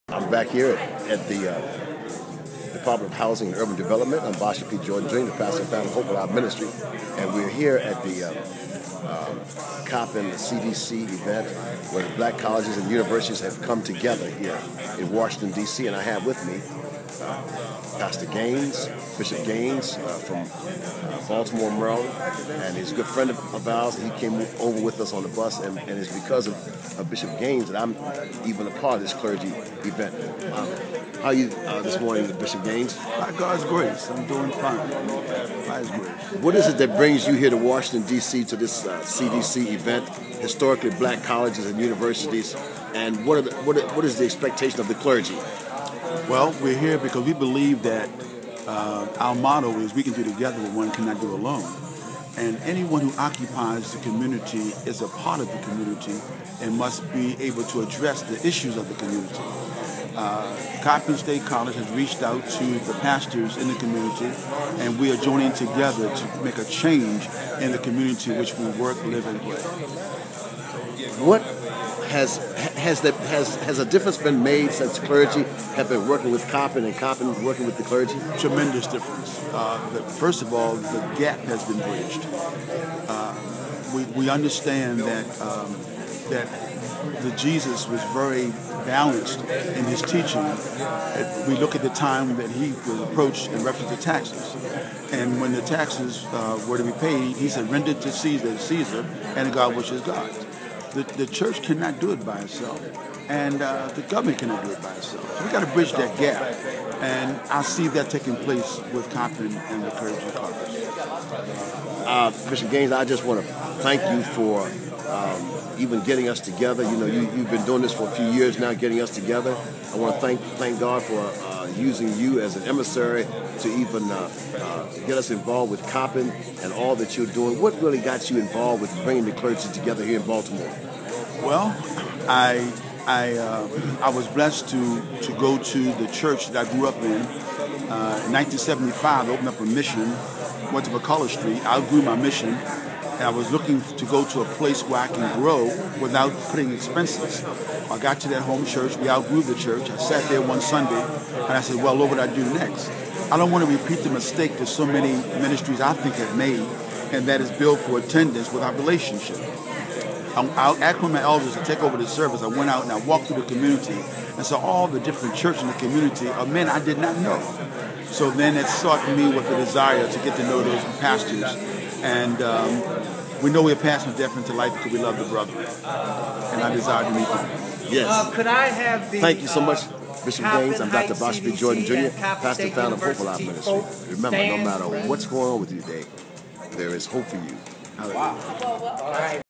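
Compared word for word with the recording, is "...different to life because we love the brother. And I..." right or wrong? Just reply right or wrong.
right.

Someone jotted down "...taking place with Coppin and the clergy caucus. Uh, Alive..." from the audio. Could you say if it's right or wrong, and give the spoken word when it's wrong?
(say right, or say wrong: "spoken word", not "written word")
wrong: "Bishop", not "Alive".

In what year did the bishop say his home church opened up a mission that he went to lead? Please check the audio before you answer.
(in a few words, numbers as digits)
1975.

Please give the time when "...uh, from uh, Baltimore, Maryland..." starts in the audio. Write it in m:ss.
0:19.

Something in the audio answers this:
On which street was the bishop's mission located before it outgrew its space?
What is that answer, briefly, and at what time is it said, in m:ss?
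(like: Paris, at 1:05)
McCulloh Street, at 2:20.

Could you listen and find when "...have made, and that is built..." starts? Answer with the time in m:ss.
2:36.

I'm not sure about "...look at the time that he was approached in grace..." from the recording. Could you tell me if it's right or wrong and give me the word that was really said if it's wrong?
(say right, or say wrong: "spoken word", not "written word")
wrong: "reference", not "grace".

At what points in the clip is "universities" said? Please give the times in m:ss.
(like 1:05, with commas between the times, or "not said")
0:12, 0:41.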